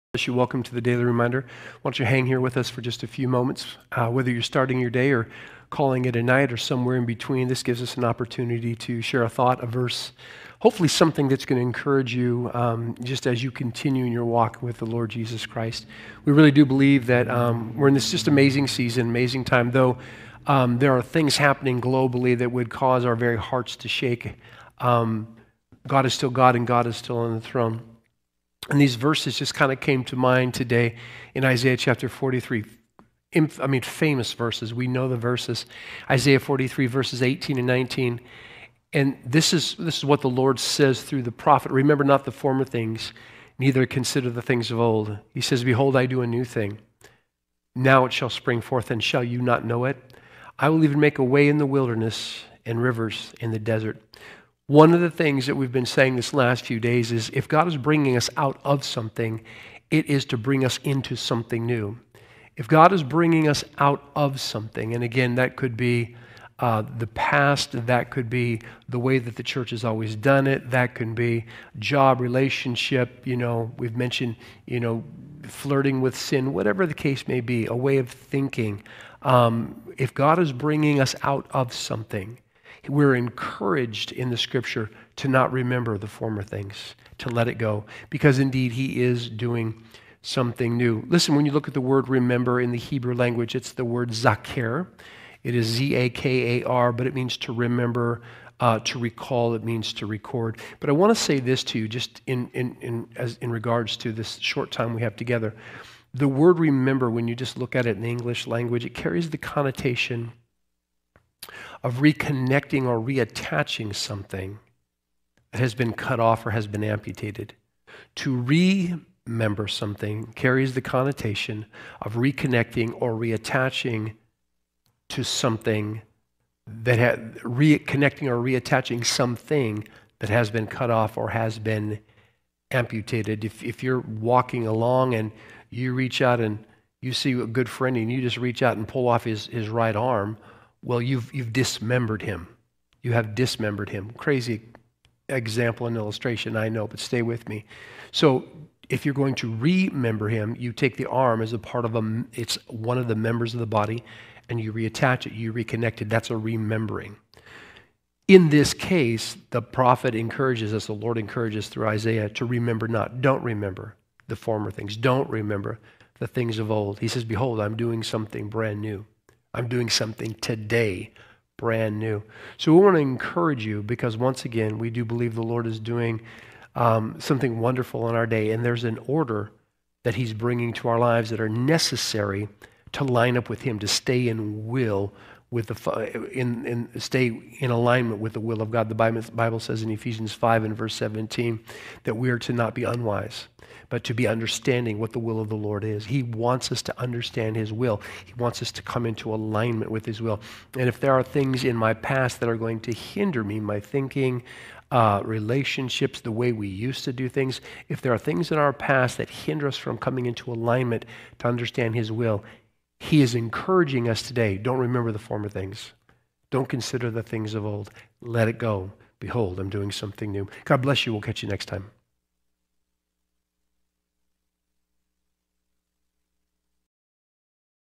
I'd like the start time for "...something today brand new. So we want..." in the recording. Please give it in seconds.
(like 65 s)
169 s.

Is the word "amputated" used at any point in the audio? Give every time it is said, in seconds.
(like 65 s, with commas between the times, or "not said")
116 s, 132 s.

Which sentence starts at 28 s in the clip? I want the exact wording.
And these verses just kind of came to mind today in Isaiah chapter 43.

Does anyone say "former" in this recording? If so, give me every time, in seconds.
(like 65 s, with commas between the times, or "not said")
42 s, 86 s, 164 s, 215 s.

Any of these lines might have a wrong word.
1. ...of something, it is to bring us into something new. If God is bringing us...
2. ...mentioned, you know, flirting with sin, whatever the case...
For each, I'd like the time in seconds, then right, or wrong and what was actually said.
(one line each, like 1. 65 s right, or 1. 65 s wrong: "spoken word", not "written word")
1. 58 s right
2. 73 s right.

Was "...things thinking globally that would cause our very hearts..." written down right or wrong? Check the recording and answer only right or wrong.
wrong.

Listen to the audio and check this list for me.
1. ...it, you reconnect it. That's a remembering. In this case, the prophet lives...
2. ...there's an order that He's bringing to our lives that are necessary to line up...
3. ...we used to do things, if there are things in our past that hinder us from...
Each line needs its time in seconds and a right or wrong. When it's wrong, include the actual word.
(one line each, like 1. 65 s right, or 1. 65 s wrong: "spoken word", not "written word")
1. 155 s wrong: "encourages", not "lives"
2. 178 s right
3. 206 s right.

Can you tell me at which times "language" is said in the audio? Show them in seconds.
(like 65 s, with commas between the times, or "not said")
93 s, 108 s.